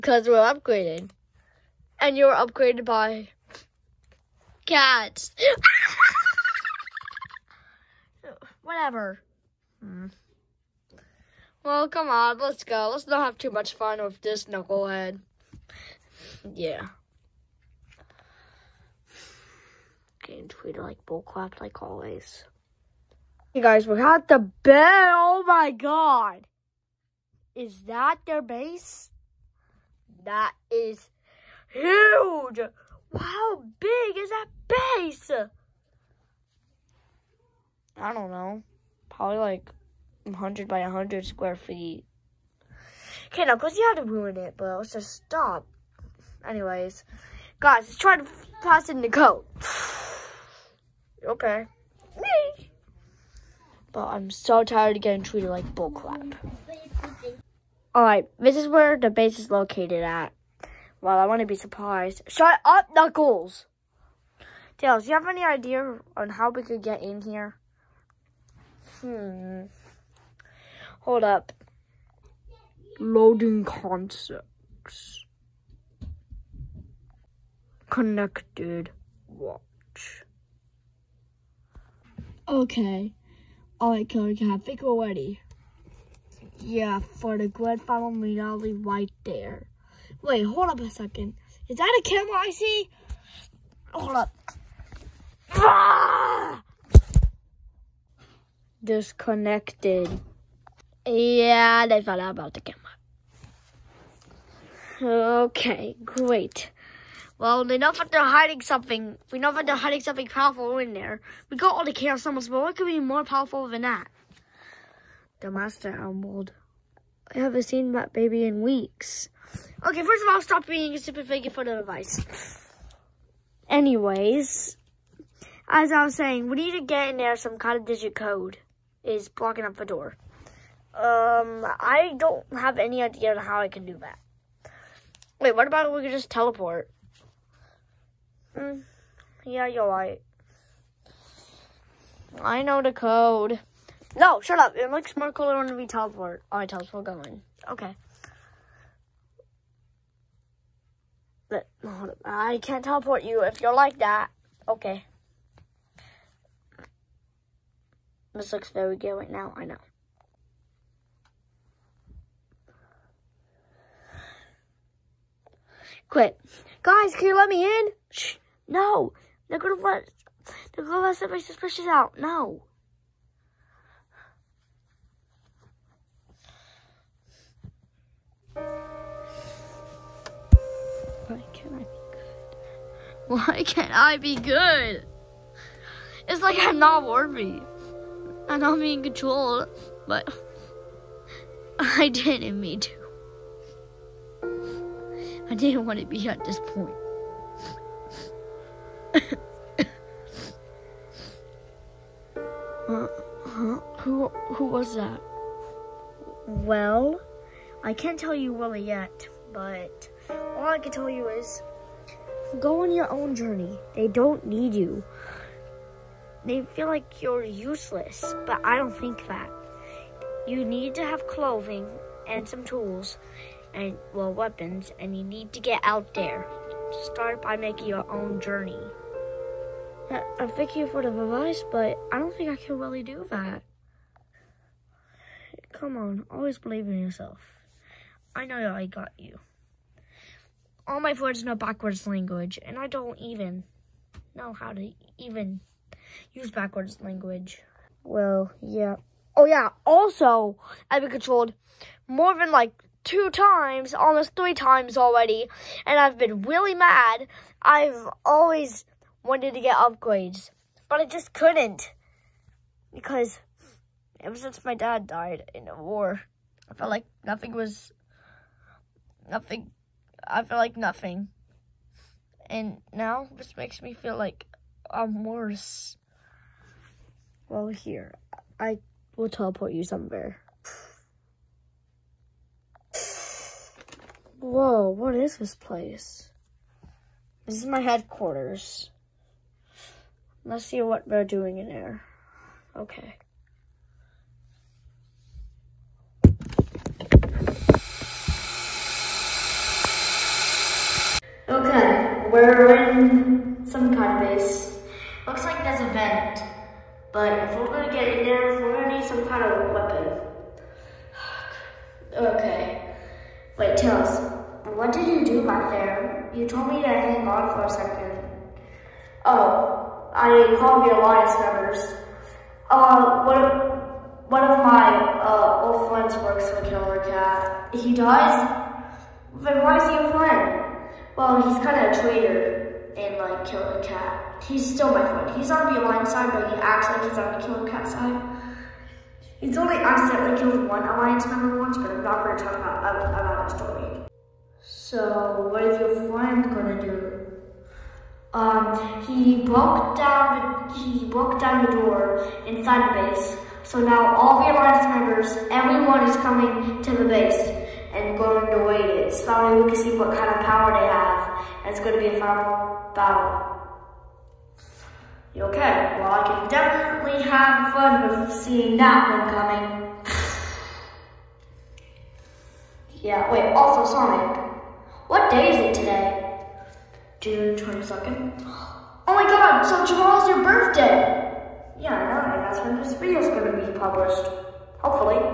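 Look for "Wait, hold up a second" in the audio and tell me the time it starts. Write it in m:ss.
1:30.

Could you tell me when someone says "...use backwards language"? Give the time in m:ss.
4:06.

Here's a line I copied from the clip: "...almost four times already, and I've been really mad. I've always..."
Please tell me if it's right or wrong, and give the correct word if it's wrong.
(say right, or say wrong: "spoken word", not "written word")
wrong: "three", not "four".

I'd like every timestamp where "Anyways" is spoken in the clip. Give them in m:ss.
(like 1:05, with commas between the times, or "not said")
0:46, 2:03.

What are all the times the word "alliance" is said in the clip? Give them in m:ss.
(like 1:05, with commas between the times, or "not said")
5:20, 5:35, 5:40, 5:54.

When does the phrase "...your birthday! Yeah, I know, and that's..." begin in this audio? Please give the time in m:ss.
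6:20.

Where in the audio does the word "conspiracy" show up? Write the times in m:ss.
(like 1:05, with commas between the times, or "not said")
not said.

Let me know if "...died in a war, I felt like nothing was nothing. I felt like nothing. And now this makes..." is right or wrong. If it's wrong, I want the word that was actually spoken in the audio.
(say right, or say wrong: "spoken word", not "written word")
right.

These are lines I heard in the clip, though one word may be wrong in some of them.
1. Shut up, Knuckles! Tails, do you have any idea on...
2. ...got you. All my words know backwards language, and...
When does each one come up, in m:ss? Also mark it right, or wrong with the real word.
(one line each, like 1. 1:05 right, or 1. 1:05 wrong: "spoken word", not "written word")
1. 1:02 right
2. 3:58 right.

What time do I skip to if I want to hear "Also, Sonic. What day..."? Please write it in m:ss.
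6:13.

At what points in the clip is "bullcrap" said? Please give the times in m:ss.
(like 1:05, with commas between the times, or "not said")
0:21, 0:55.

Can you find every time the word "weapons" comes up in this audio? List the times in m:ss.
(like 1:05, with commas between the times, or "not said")
3:44, 5:09.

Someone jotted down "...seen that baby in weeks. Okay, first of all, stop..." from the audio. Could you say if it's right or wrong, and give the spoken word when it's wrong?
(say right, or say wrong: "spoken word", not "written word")
right.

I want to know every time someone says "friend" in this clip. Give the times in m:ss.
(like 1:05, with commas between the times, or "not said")
5:25, 5:30, 5:35, 5:46.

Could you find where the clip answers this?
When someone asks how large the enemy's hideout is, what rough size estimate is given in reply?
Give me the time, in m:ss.
0:40.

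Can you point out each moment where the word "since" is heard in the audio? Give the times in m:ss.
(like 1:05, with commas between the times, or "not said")
4:24.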